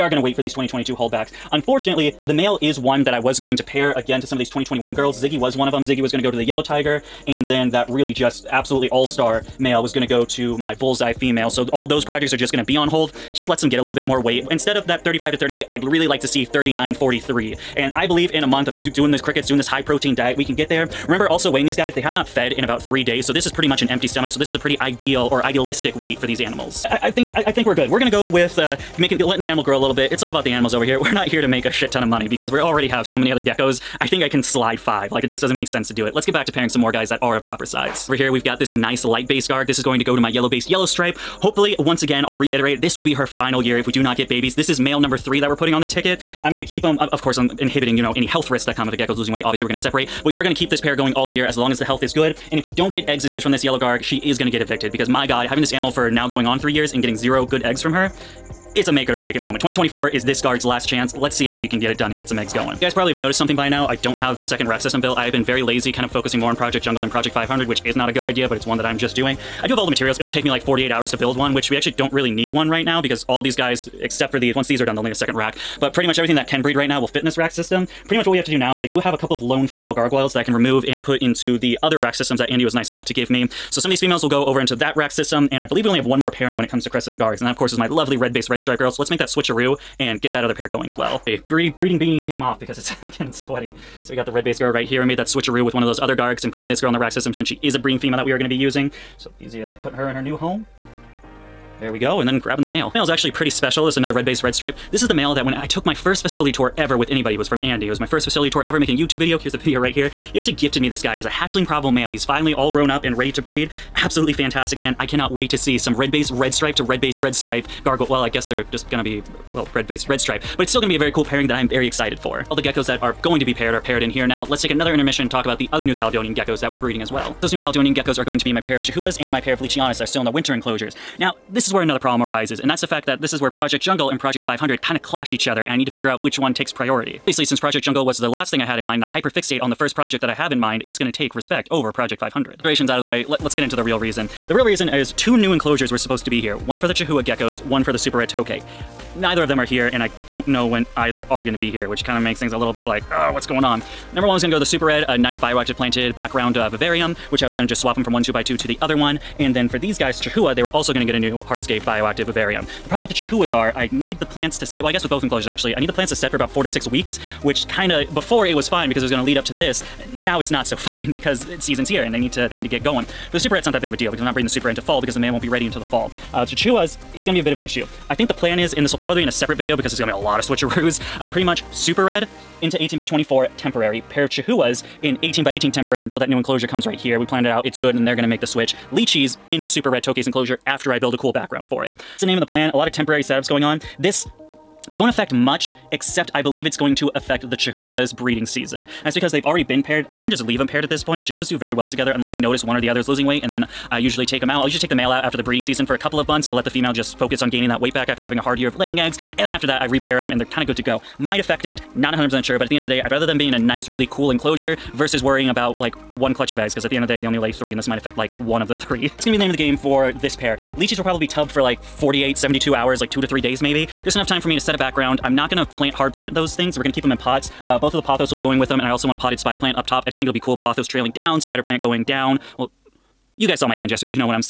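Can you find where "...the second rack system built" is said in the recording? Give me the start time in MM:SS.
01:04.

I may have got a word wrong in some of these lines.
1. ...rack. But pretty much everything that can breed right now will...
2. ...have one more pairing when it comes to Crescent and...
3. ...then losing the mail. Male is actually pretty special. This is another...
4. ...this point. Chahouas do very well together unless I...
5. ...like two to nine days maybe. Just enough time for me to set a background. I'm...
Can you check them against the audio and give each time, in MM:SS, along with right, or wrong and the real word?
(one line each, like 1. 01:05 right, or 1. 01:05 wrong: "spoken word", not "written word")
1. 01:15 right
2. 01:25 right
3. 01:42 wrong: "grabbing", not "losing"
4. 03:20 right
5. 03:43 wrong: "three", not "nine".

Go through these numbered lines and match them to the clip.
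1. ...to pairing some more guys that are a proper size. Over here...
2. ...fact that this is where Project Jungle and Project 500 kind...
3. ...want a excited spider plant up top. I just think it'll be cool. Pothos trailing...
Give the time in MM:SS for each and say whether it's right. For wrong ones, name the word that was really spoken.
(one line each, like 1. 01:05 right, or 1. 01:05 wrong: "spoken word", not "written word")
1. 00:36 right
2. 02:12 right
3. 03:49 wrong: "potted", not "excited".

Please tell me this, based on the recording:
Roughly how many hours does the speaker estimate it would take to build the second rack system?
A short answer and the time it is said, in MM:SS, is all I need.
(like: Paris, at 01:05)
48, at 01:10.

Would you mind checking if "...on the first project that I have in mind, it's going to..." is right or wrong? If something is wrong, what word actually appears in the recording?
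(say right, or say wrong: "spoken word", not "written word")
right.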